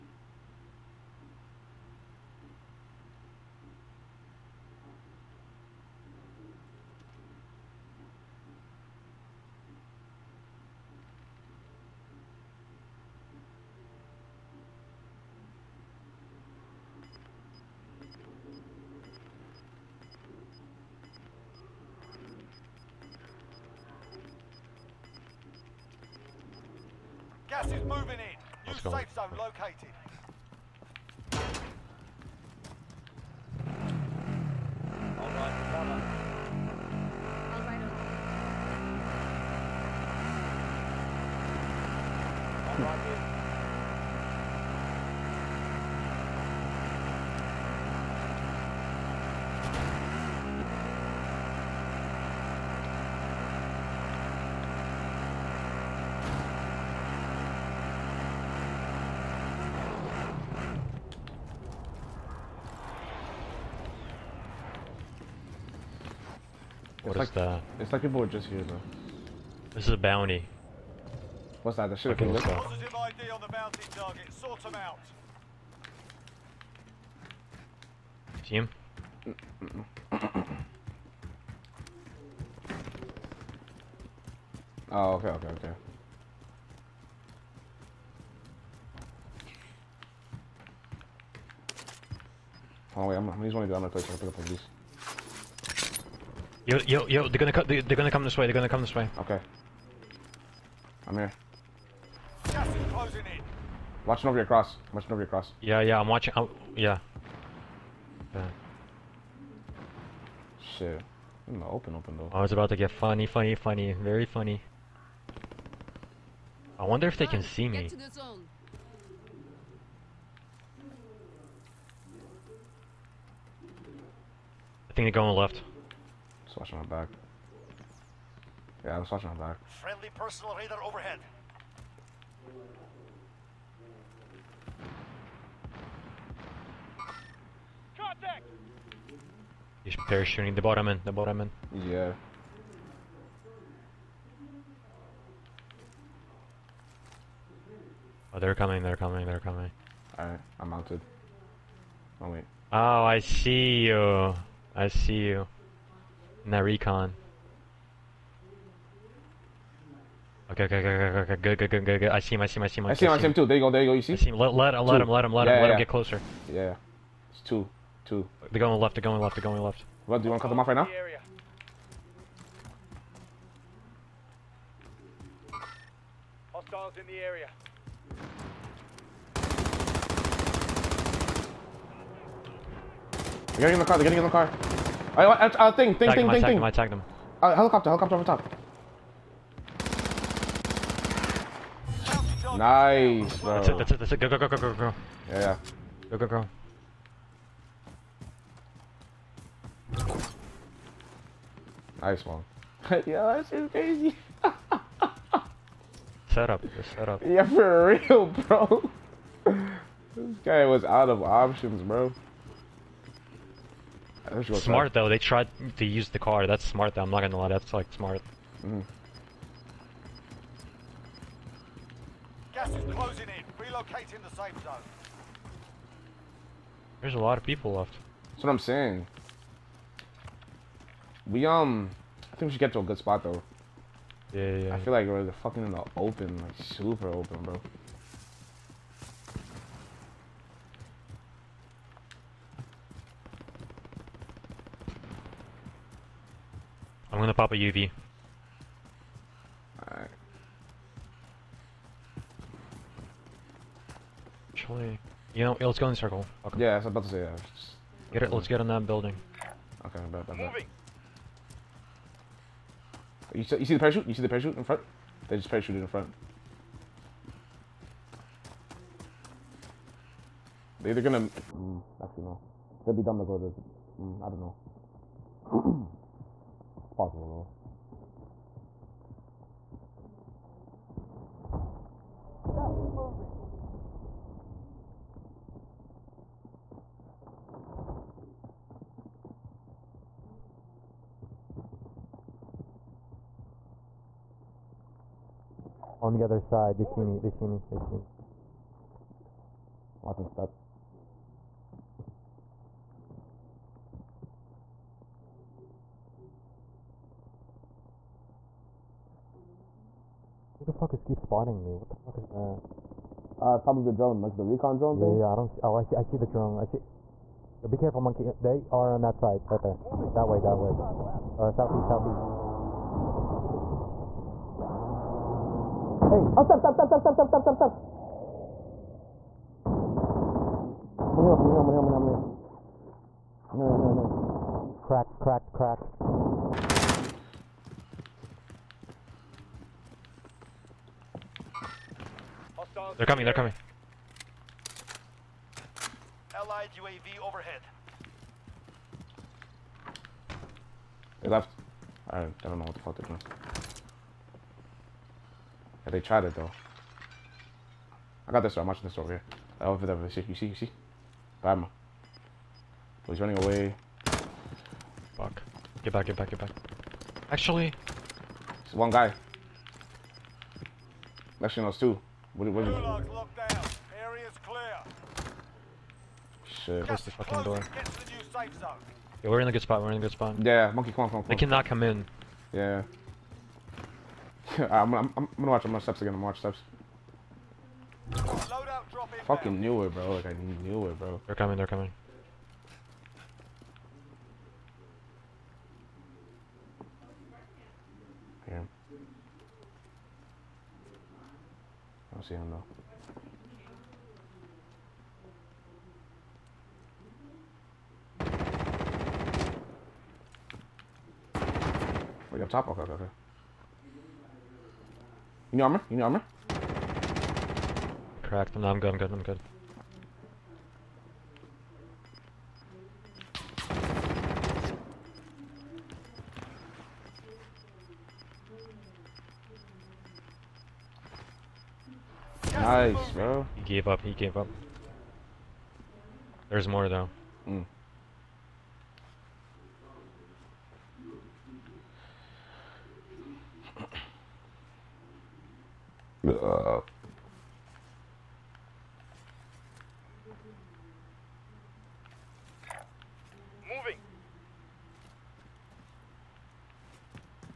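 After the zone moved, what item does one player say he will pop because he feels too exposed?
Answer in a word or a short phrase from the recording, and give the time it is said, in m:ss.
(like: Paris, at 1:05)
A UV, at 4:07.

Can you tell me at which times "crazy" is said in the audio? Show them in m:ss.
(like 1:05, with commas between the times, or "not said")
3:23.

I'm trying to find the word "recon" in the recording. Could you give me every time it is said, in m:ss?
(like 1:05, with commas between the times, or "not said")
2:36, 5:14.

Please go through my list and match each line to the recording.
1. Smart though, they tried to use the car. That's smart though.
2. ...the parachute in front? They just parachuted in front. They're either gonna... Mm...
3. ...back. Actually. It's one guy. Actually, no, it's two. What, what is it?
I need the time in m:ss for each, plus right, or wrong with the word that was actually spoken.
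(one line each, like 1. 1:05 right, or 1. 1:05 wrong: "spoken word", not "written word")
1. 3:34 right
2. 4:24 right
3. 6:06 right.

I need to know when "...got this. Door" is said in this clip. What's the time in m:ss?
5:58.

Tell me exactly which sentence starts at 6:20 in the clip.
Yeah, monkey, come on, come on.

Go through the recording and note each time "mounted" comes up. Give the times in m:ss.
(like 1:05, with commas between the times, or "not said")
2:30.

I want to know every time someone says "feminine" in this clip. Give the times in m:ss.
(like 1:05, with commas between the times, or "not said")
not said.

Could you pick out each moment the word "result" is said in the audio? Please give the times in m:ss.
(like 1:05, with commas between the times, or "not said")
not said.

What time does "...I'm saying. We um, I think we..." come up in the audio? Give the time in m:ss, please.
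3:48.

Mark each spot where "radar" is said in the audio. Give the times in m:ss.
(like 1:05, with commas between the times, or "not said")
2:10.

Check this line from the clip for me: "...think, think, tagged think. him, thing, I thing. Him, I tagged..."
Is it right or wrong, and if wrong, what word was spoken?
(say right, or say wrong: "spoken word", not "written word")
right.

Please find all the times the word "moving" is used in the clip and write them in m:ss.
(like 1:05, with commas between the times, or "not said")
0:27, 7:33.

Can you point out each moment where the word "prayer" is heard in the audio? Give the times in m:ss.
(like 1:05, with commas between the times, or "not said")
not said.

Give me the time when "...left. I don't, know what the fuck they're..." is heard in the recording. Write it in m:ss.
5:51.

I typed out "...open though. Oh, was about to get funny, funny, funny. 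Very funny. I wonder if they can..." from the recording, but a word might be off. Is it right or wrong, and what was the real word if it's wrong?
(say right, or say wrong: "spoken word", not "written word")
right.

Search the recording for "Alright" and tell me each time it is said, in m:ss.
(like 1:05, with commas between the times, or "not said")
2:30, 4:09.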